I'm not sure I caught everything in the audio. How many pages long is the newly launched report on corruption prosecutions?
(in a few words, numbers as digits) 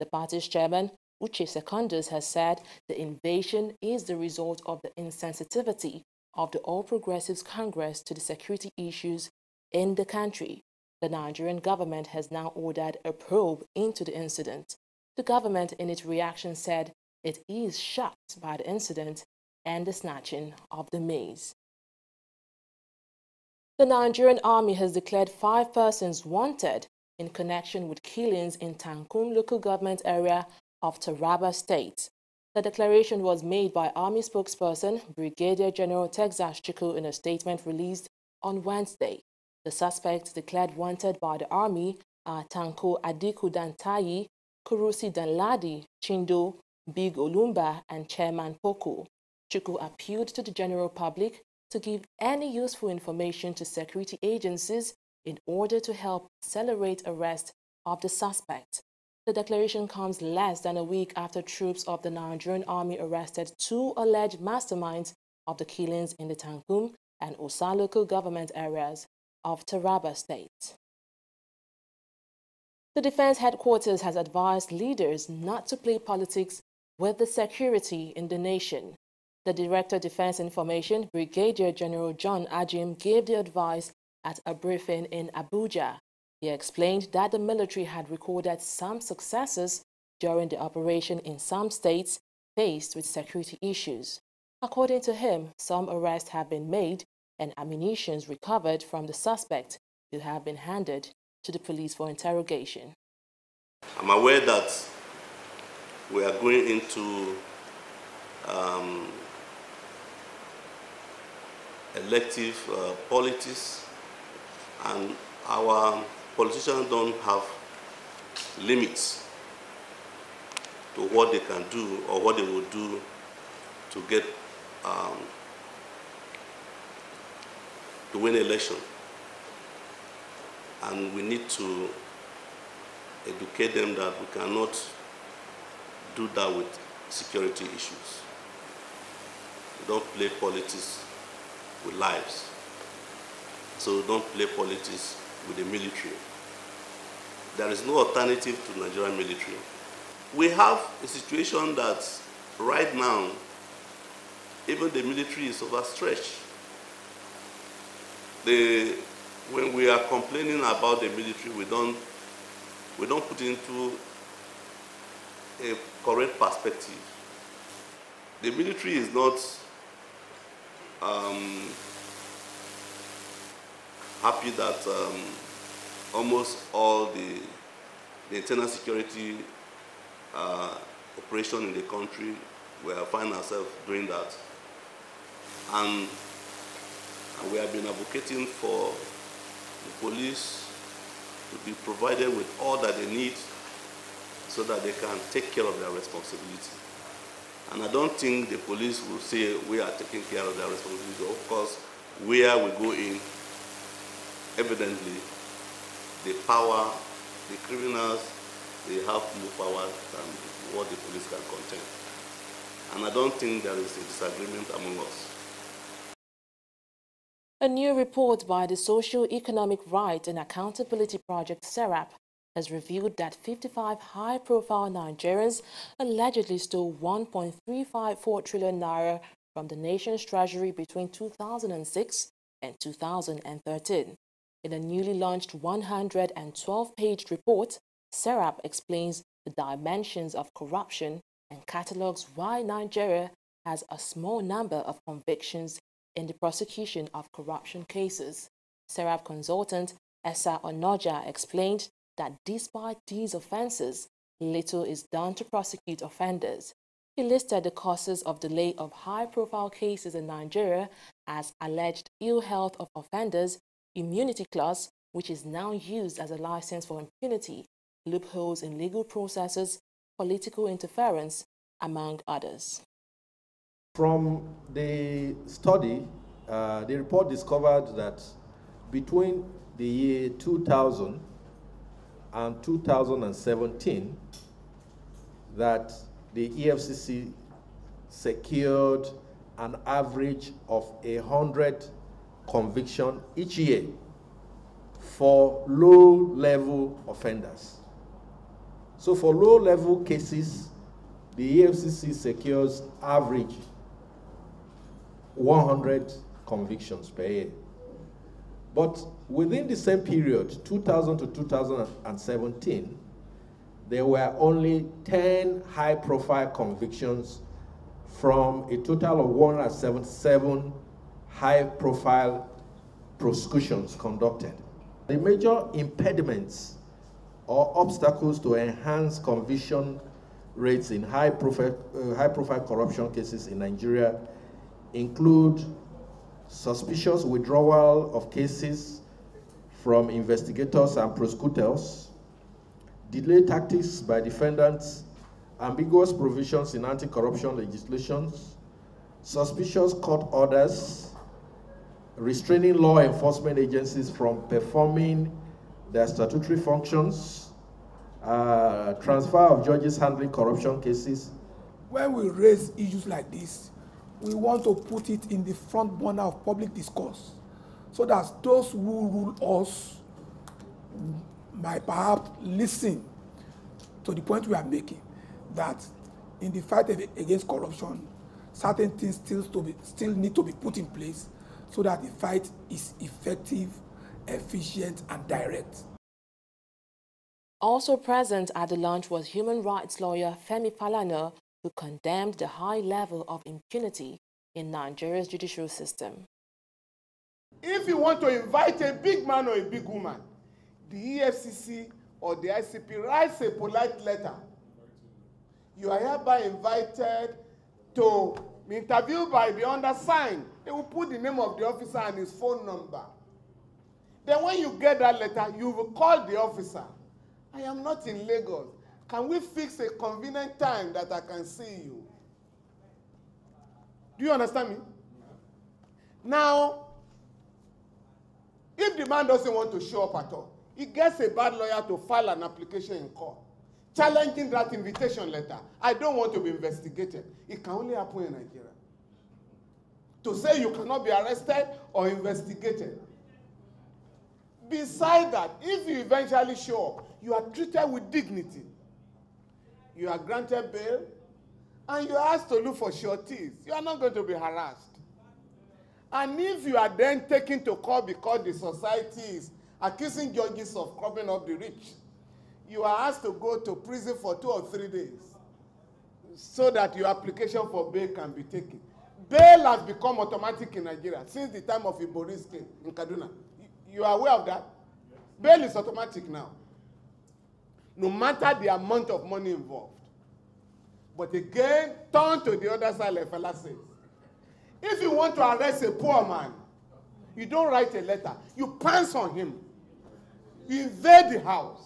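112.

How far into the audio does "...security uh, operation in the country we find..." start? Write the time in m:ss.
2:58.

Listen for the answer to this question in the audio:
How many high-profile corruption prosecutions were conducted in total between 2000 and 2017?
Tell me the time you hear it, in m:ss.
5:19.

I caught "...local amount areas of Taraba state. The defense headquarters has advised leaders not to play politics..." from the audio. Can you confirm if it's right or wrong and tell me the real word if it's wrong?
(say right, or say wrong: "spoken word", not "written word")
wrong: "government", not "amount".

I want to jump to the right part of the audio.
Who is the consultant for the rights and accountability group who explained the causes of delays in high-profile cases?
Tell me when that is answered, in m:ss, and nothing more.
4:10.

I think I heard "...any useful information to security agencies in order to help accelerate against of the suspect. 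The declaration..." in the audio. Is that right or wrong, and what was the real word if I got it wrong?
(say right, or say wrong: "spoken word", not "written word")
wrong: "arrest", not "against".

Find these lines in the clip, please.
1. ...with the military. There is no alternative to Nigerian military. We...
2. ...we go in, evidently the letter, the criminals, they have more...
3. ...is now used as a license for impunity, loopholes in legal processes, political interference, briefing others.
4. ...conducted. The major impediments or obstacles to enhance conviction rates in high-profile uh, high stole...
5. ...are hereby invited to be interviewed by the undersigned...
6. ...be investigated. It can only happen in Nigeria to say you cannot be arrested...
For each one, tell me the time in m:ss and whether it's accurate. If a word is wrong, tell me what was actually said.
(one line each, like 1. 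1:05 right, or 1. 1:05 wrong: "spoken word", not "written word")
1. 2:25 right
2. 3:22 wrong: "power", not "letter"
3. 4:25 wrong: "among", not "briefing"
4. 5:23 wrong: "profile", not "stole"
5. 6:45 right
6. 7:16 right.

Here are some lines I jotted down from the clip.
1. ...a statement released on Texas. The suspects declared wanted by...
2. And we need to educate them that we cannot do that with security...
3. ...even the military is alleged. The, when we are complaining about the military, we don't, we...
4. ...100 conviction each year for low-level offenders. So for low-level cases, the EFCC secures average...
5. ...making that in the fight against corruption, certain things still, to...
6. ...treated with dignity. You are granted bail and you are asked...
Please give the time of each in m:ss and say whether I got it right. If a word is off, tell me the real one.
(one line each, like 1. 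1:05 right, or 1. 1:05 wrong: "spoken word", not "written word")
1. 0:37 wrong: "Wednesday", not "Texas"
2. 2:10 right
3. 2:34 wrong: "overstretched", not "alleged"
4. 4:51 right
5. 6:14 right
6. 7:27 right.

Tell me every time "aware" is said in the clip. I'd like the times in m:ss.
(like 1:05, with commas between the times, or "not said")
1:44, 7:54.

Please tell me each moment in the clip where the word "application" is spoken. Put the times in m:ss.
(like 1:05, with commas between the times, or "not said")
7:12, 7:47.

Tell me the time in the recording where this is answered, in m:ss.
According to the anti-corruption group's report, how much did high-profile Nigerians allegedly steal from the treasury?
3:47.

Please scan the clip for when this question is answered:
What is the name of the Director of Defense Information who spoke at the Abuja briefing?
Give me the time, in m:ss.
1:22.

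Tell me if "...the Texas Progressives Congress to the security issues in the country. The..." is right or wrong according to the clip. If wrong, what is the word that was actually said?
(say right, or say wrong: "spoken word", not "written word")
wrong: "All", not "Texas".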